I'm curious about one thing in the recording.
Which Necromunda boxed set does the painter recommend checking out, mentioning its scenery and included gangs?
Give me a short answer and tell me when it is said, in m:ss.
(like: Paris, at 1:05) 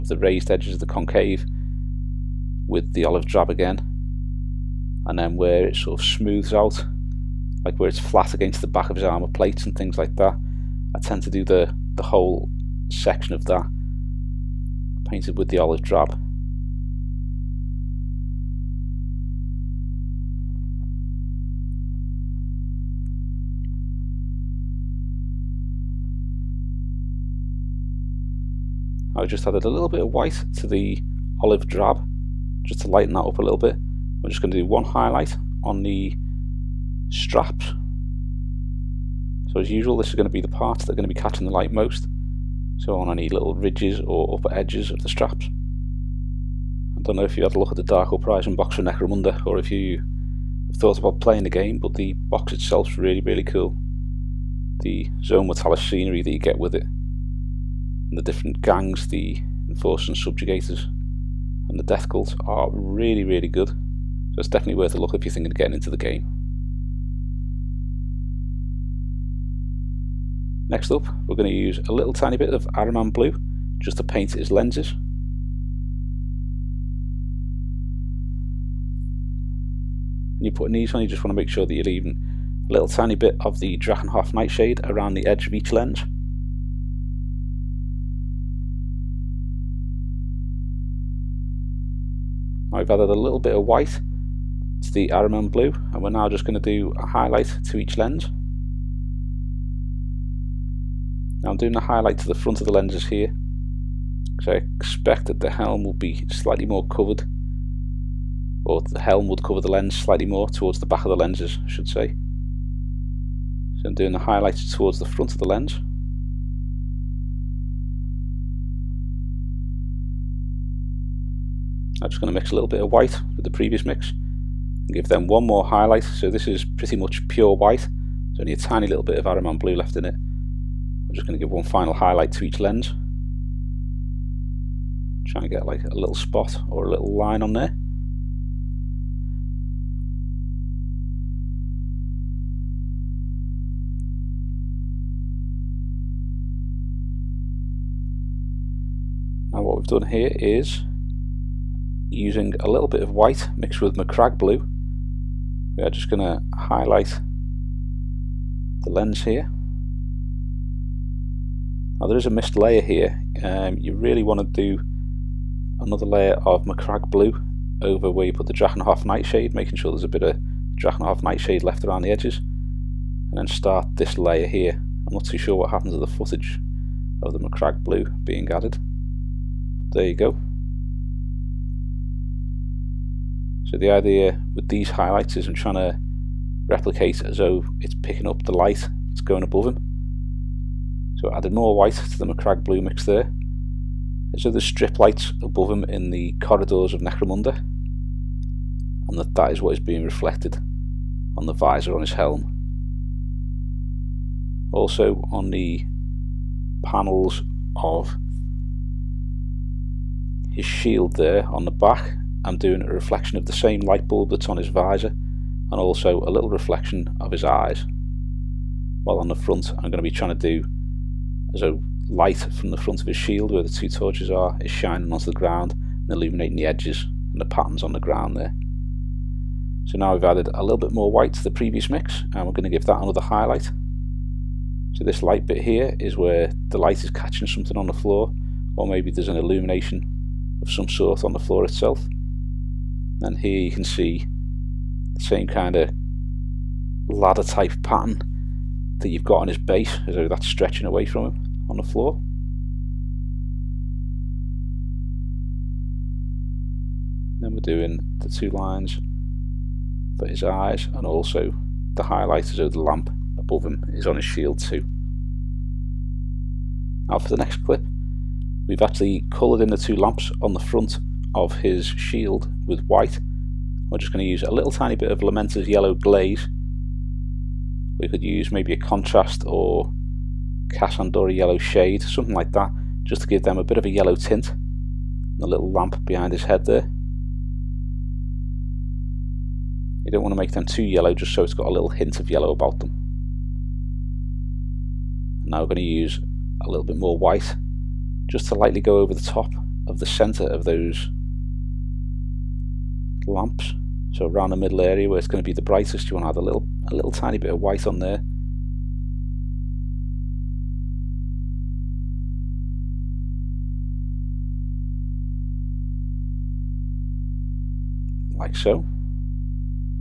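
Dark Uprising, at 0:47.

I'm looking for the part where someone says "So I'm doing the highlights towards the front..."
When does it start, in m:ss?
1:53.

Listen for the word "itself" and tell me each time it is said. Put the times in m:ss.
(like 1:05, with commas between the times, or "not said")
0:52, 4:01.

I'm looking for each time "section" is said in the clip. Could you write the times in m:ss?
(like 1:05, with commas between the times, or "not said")
0:12.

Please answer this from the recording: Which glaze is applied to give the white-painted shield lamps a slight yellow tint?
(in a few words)
Lamenter's yellow glaze.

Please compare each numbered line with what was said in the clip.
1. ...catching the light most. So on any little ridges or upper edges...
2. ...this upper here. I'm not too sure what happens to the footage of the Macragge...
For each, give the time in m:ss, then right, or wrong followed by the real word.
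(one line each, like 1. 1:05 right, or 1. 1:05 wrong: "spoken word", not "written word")
1. 0:41 right
2. 2:53 wrong: "layer", not "upper".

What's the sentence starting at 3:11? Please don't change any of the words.
So I added more white to the Macragge blue mix there.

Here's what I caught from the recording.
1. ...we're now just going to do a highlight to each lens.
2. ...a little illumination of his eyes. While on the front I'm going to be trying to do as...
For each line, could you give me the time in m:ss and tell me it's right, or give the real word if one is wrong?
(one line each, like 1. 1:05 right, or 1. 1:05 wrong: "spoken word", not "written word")
1. 1:36 right
2. 3:36 wrong: "reflection", not "illumination".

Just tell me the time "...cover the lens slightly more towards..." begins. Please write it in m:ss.
1:49.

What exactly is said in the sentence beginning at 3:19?
And that, that is what is being reflected on the visor on his helm.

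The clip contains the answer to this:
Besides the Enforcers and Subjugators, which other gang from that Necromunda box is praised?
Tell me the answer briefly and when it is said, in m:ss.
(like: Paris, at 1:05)
Death Cult, at 1:01.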